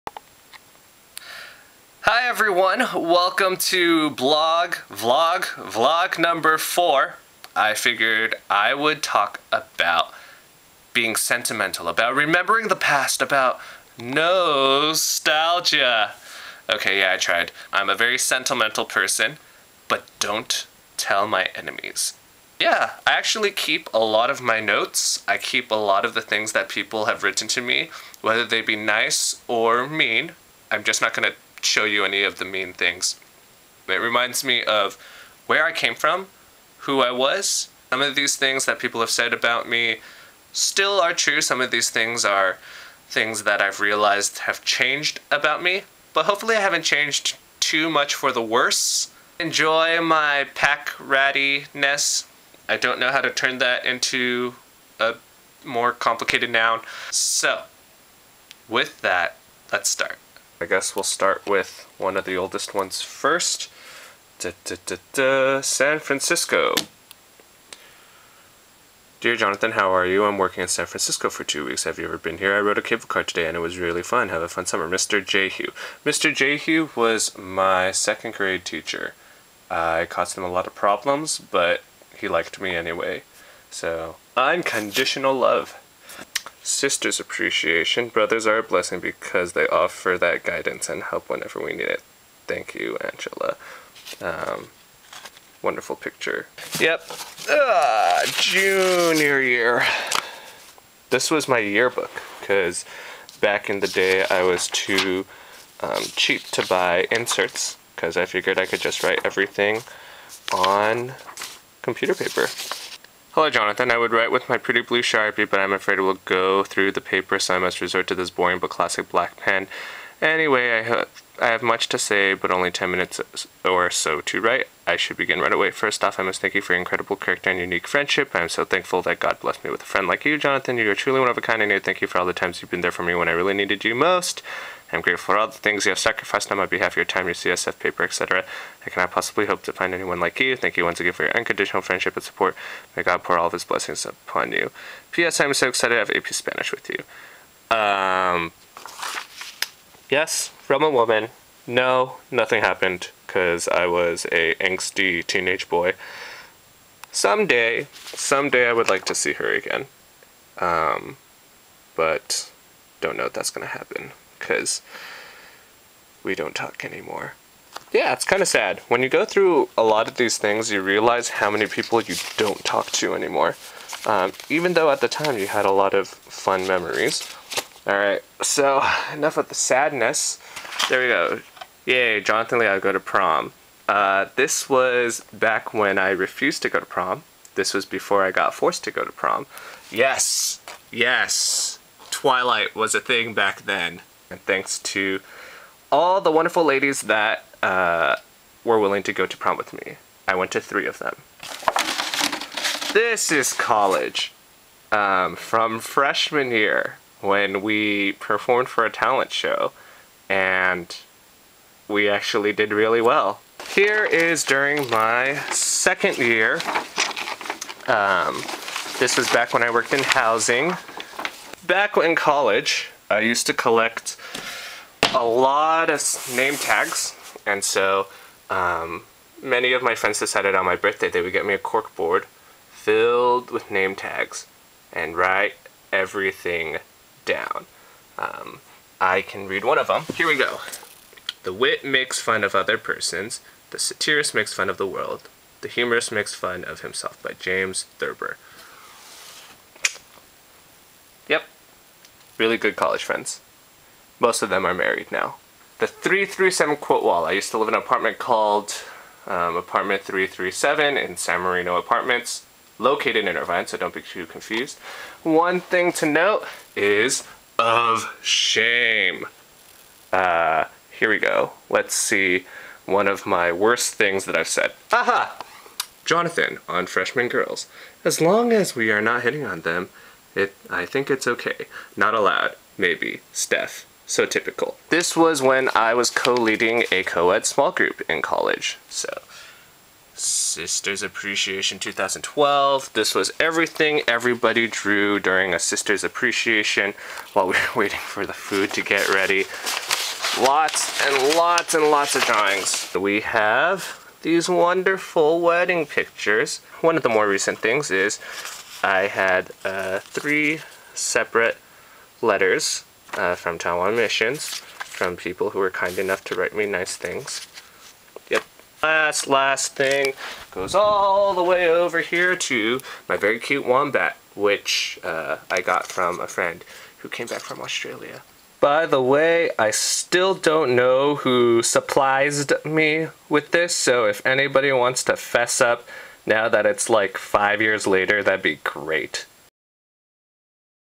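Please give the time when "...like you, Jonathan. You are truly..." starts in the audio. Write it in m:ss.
2:10.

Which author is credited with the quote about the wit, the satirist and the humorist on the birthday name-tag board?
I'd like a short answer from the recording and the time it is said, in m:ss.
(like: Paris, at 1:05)
James Thurber, at 4:07.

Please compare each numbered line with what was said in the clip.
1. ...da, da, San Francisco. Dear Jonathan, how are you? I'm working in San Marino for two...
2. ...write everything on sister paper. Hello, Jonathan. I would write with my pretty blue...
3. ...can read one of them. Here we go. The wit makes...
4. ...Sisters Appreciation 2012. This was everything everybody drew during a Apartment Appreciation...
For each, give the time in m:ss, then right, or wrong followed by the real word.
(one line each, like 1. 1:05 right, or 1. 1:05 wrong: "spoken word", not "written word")
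1. 1:04 wrong: "Francisco", not "Marino"
2. 1:49 wrong: "computer", not "sister"
3. 3:59 right
4. 4:50 wrong: "Sisters", not "Apartment".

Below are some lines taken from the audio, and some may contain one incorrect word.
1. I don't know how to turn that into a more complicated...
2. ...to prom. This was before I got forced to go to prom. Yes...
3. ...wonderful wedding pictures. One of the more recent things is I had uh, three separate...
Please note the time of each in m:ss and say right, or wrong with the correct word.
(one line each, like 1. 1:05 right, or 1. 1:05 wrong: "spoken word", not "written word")
1. 0:52 right
2. 3:06 right
3. 5:04 right.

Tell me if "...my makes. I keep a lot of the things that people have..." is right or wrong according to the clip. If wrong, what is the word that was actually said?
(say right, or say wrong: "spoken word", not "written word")
wrong: "notes", not "makes".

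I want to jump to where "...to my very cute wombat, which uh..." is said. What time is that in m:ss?
5:22.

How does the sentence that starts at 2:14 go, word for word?
I'm grateful for all the things you have sacrificed on my behalf, your time, your CSF paper, etc.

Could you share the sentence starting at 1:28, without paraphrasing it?
Brothers are a blessing because they offer that guidance and help whenever we need it.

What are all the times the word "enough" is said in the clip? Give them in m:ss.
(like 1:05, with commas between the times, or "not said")
2:59, 5:15.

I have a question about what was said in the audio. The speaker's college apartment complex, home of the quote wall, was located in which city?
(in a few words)
Irvine.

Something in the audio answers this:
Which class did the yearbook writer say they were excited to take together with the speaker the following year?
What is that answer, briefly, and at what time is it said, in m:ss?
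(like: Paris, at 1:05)
AP Spanish, at 2:26.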